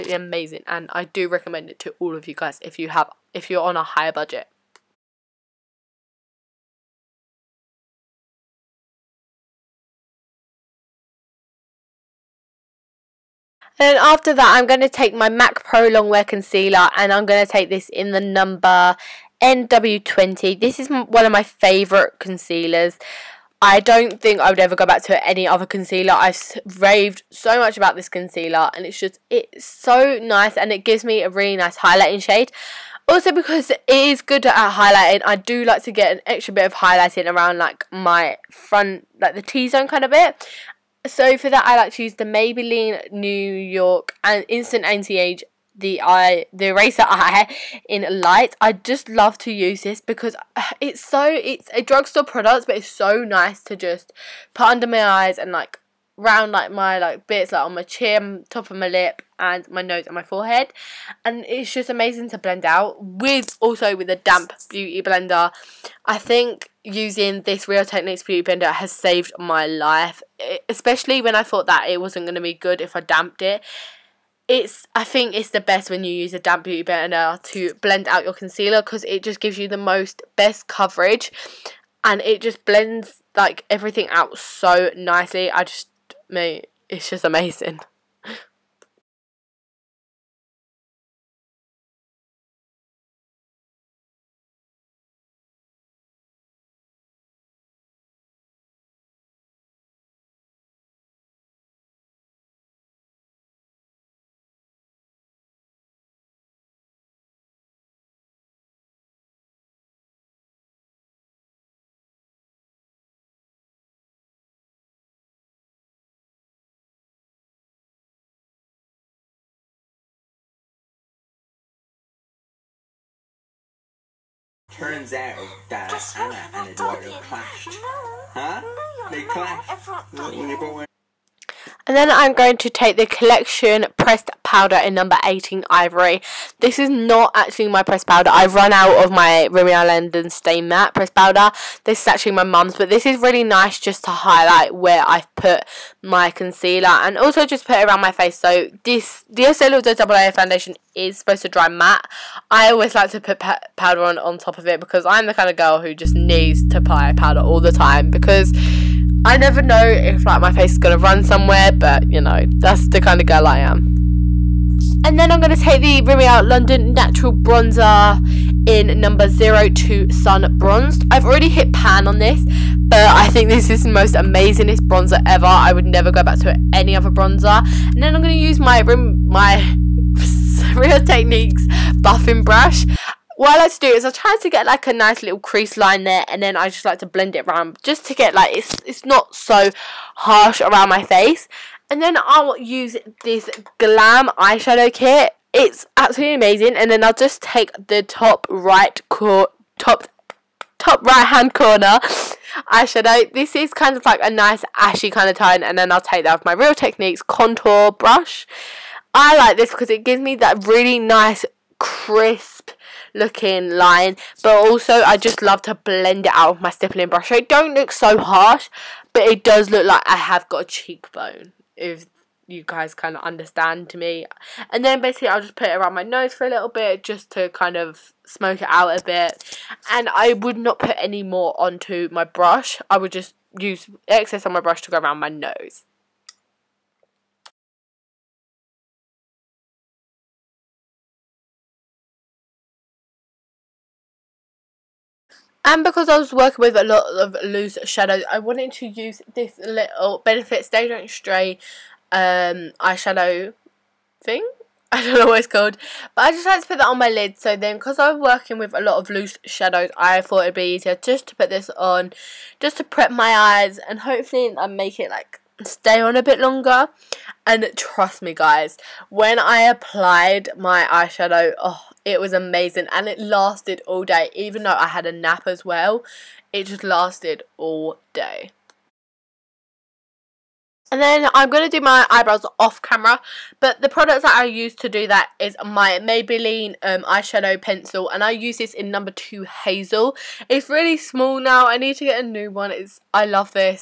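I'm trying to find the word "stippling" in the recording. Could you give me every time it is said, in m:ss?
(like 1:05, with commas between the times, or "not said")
3:36.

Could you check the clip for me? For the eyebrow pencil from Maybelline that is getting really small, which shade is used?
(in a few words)
Hazel.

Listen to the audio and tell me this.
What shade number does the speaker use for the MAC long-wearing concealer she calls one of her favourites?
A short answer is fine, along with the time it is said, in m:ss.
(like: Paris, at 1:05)
NW20, at 0:19.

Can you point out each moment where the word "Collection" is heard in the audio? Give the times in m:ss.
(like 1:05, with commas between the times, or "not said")
2:13.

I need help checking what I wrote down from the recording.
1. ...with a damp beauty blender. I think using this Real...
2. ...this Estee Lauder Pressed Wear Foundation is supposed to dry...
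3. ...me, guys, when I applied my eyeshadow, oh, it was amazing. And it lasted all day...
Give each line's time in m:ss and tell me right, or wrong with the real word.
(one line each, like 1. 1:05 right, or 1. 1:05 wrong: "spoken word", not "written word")
1. 1:03 right
2. 2:28 wrong: "Double", not "Pressed"
3. 4:28 right.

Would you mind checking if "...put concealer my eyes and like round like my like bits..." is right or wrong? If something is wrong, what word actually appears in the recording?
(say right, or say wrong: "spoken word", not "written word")
wrong: "under", not "concealer".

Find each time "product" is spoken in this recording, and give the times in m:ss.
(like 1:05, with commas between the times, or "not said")
0:52, 4:43.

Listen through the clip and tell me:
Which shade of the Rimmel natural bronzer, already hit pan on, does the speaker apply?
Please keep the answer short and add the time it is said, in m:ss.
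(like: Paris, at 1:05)
Sun Bronzed, at 2:50.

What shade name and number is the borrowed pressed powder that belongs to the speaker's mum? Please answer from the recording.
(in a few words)
18 Ivory.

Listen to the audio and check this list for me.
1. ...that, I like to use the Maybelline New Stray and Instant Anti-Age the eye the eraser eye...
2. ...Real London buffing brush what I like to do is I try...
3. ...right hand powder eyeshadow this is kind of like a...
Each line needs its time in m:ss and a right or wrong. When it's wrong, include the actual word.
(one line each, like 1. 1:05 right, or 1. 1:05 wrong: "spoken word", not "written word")
1. 0:41 wrong: "York", not "Stray"
2. 3:00 wrong: "Techniques", not "London"
3. 3:21 wrong: "corner", not "powder".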